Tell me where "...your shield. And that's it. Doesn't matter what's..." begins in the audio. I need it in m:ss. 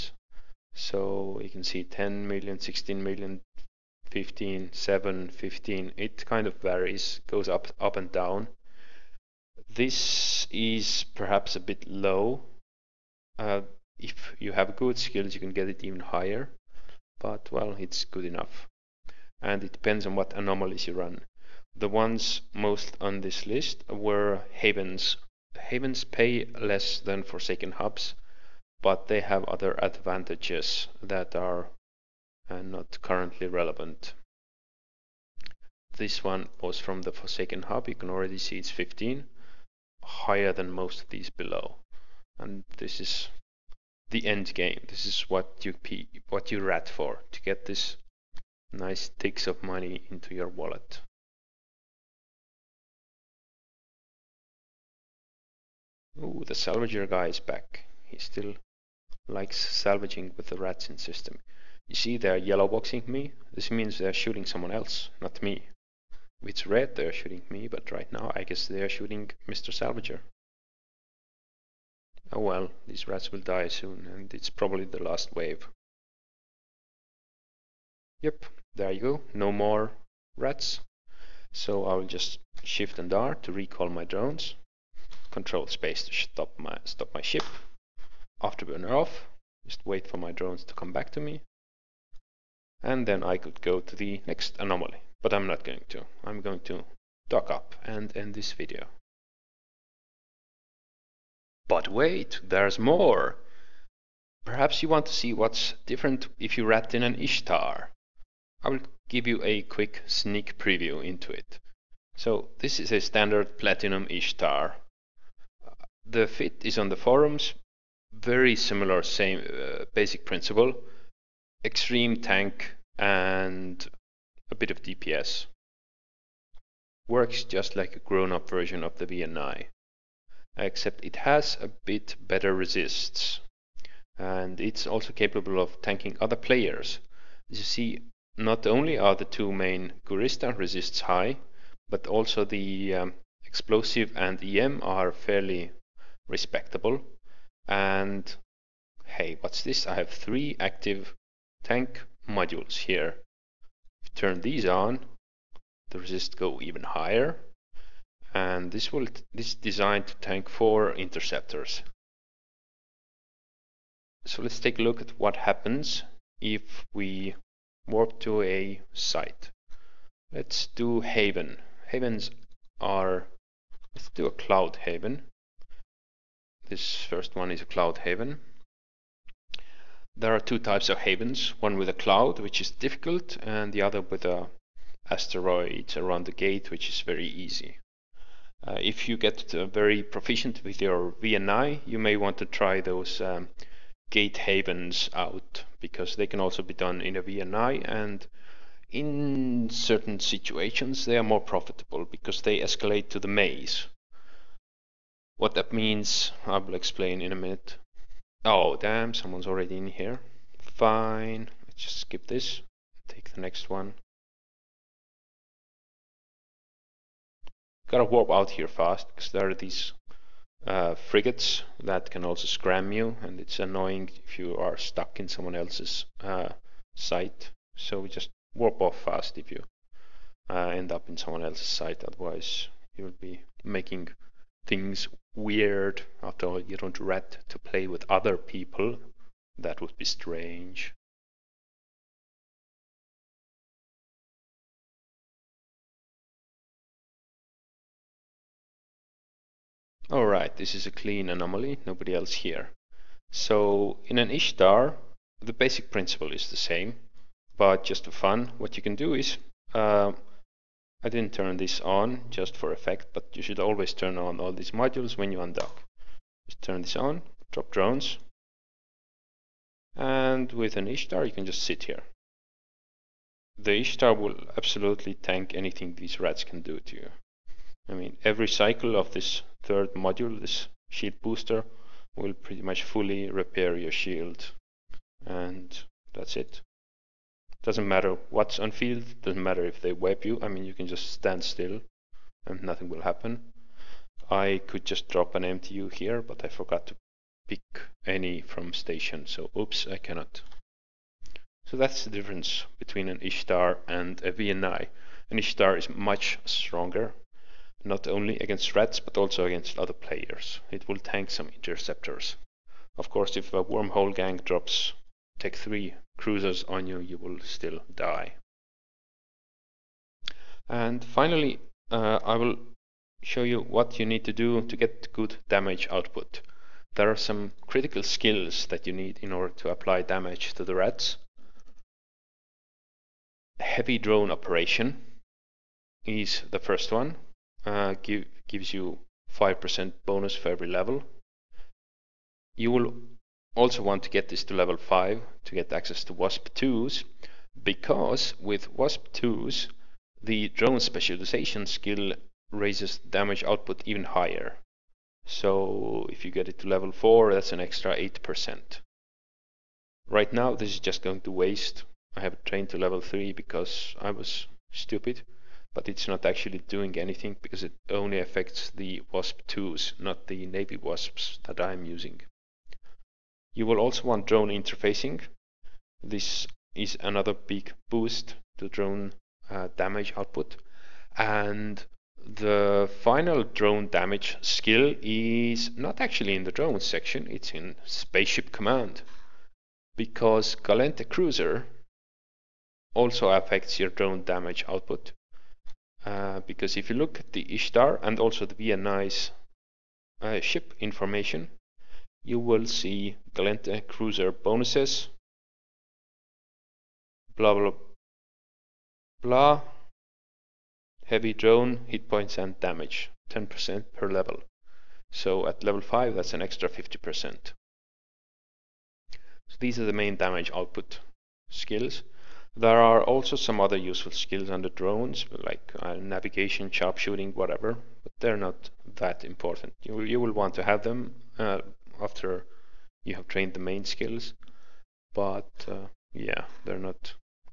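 4:43.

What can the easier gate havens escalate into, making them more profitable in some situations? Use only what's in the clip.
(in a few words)
the maze.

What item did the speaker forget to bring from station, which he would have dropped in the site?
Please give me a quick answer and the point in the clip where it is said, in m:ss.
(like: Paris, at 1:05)
MTU, at 4:55.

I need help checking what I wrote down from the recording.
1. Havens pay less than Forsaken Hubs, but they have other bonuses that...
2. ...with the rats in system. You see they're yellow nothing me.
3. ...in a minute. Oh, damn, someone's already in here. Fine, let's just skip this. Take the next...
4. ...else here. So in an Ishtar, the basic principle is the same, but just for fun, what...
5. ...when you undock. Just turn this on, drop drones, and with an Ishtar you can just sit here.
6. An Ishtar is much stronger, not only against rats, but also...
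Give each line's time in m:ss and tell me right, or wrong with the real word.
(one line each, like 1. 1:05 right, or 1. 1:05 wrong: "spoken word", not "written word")
1. 0:25 wrong: "advantages", not "bonuses"
2. 1:00 wrong: "boxing", not "nothing"
3. 3:27 right
4. 4:12 right
5. 4:25 right
6. 5:05 right.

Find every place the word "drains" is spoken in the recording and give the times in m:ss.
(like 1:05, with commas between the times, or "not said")
not said.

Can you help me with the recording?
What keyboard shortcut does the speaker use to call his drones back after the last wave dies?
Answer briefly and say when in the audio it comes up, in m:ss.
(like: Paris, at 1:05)
Shift and R, at 1:22.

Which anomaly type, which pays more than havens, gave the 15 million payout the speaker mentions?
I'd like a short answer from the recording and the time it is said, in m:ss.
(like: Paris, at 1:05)
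Forsaken Hub, at 0:37.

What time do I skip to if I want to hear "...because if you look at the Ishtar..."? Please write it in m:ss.
6:36.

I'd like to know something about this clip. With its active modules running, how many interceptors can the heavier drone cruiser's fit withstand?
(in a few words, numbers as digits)
4.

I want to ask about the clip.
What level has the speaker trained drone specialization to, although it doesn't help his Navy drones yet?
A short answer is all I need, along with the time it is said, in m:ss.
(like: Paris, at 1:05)
3, at 6:02.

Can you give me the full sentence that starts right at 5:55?
So if you get it to level 4 that's an extra 8%.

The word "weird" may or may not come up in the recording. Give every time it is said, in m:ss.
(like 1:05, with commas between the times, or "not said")
3:55.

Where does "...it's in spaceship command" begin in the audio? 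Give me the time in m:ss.
6:27.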